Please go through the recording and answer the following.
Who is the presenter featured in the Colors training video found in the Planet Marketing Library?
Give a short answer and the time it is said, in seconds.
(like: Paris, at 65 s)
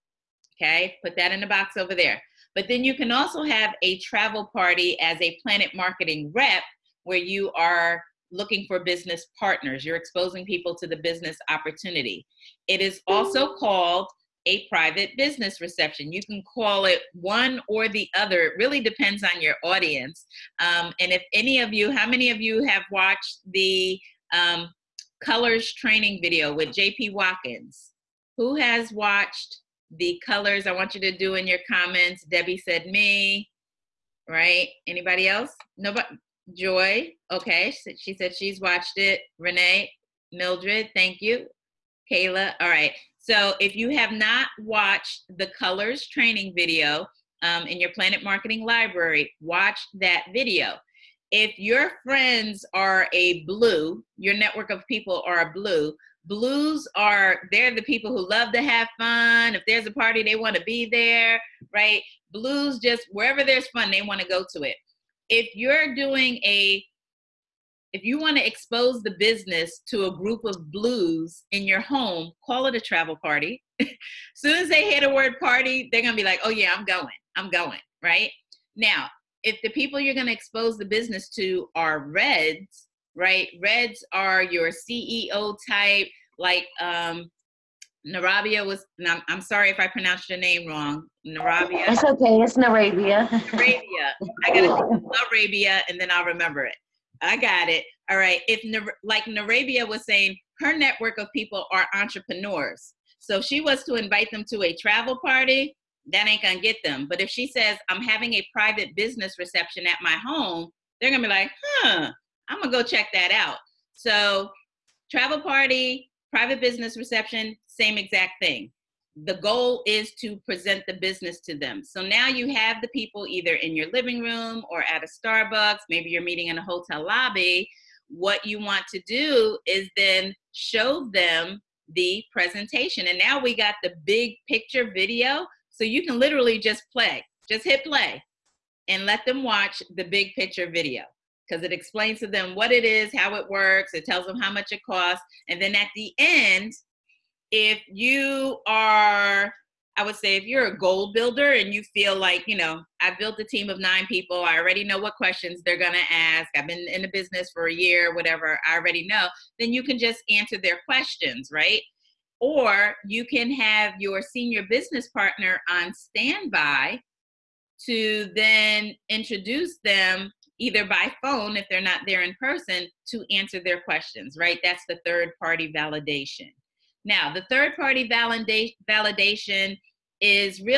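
JP Watkins, at 26 s.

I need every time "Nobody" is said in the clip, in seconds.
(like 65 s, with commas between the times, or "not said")
35 s.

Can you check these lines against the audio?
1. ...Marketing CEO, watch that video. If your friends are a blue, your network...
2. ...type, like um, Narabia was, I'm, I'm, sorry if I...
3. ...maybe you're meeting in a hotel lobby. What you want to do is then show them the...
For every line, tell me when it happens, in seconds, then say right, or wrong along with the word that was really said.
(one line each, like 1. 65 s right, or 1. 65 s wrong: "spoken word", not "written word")
1. 48 s wrong: "Library", not "CEO"
2. 85 s right
3. 125 s right.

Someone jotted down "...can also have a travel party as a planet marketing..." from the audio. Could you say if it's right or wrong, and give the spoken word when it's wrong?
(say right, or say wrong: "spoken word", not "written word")
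right.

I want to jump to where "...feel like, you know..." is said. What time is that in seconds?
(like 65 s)
151 s.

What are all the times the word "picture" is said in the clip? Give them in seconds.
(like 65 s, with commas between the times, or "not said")
134 s, 140 s.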